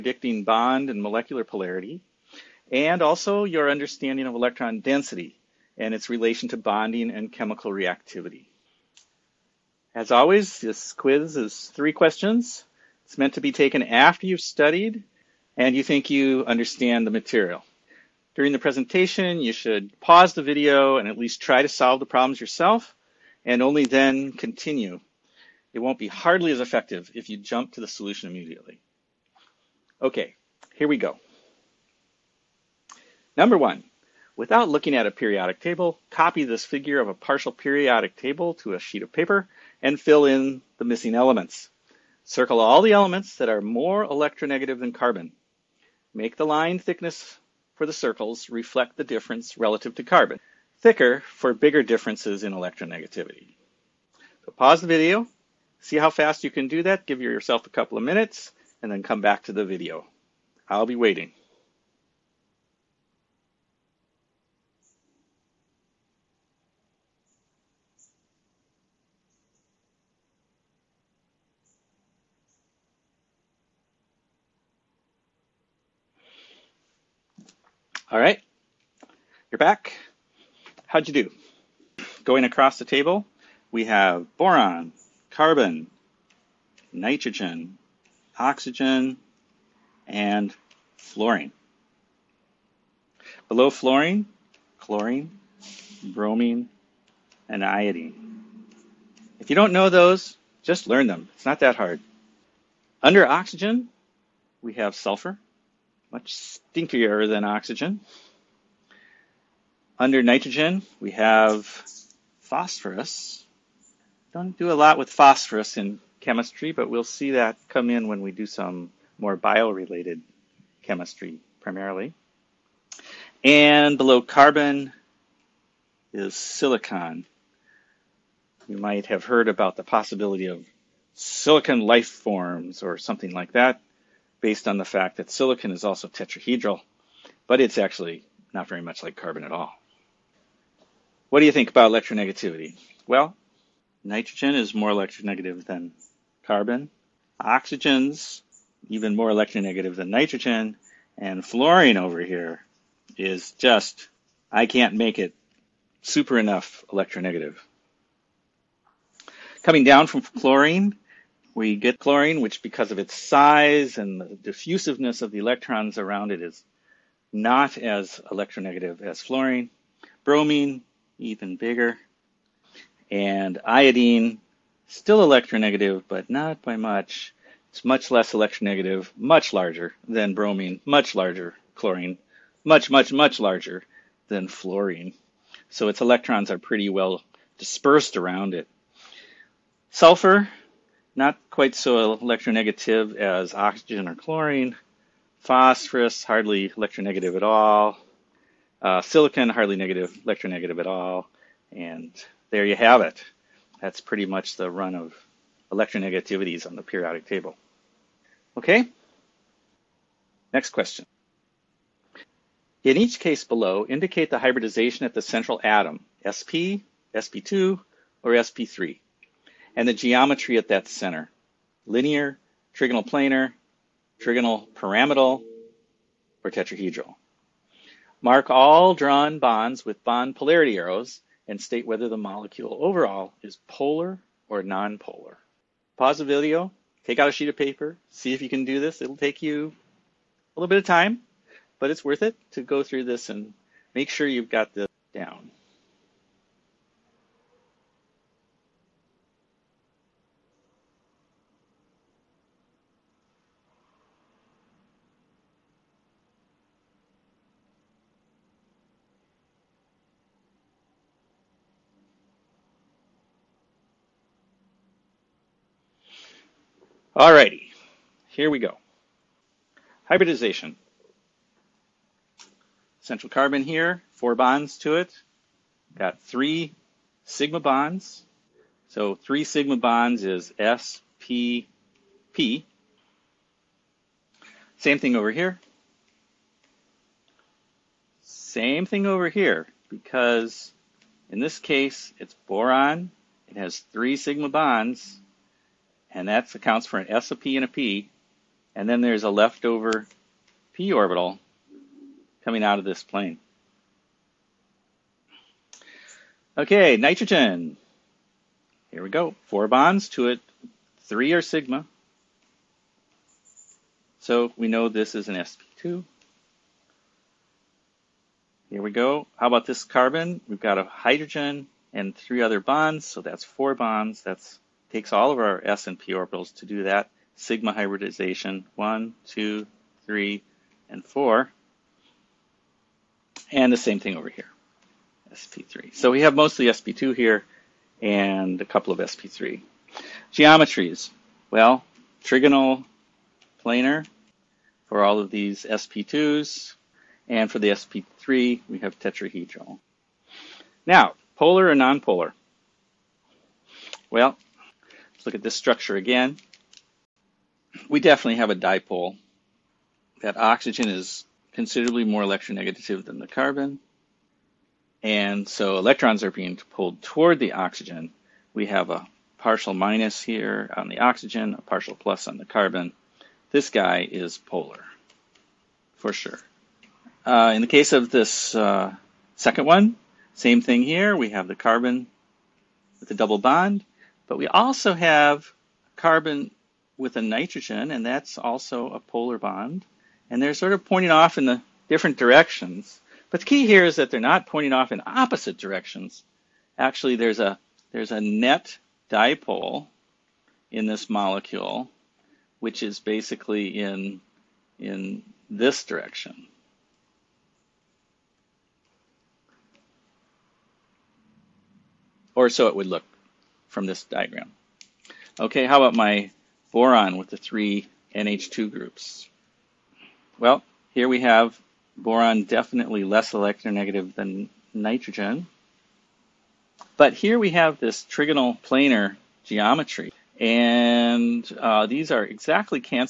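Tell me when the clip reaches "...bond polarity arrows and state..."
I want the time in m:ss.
3:50.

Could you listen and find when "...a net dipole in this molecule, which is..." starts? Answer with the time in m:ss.
6:38.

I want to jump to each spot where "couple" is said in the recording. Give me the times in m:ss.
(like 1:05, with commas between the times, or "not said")
0:57, 5:38.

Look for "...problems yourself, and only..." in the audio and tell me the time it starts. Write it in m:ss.
0:22.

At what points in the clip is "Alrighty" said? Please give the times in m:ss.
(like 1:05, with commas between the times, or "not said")
4:27.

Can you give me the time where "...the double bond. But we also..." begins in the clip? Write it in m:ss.
6:23.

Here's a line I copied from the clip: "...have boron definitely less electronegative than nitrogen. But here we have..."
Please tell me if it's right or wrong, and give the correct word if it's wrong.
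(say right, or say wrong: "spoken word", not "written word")
right.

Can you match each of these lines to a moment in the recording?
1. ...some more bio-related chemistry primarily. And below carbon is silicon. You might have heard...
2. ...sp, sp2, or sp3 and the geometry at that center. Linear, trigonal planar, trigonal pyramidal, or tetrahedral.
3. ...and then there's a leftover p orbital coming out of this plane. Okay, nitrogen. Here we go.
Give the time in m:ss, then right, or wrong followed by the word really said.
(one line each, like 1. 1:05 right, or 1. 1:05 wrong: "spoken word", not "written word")
1. 1:58 right
2. 3:36 right
3. 4:58 right.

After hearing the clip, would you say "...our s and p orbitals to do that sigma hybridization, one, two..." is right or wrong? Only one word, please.
right.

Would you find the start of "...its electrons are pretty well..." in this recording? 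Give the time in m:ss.
3:05.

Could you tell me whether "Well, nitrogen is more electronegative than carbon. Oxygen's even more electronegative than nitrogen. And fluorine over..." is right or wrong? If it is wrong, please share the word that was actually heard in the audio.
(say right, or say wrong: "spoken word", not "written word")
right.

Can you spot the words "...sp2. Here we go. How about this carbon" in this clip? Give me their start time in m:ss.
5:15.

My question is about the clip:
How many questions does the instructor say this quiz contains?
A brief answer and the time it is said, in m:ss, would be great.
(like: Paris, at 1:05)
3, at 0:11.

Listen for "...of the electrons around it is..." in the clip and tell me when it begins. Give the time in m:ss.
2:45.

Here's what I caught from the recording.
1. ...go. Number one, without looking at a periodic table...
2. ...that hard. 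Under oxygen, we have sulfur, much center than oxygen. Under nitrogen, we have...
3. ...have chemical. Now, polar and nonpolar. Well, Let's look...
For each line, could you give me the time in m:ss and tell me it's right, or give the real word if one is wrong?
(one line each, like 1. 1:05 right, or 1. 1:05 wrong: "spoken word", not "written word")
1. 0:30 right
2. 1:41 wrong: "stinkier", not "center"
3. 5:48 wrong: "tetrahedral", not "chemical".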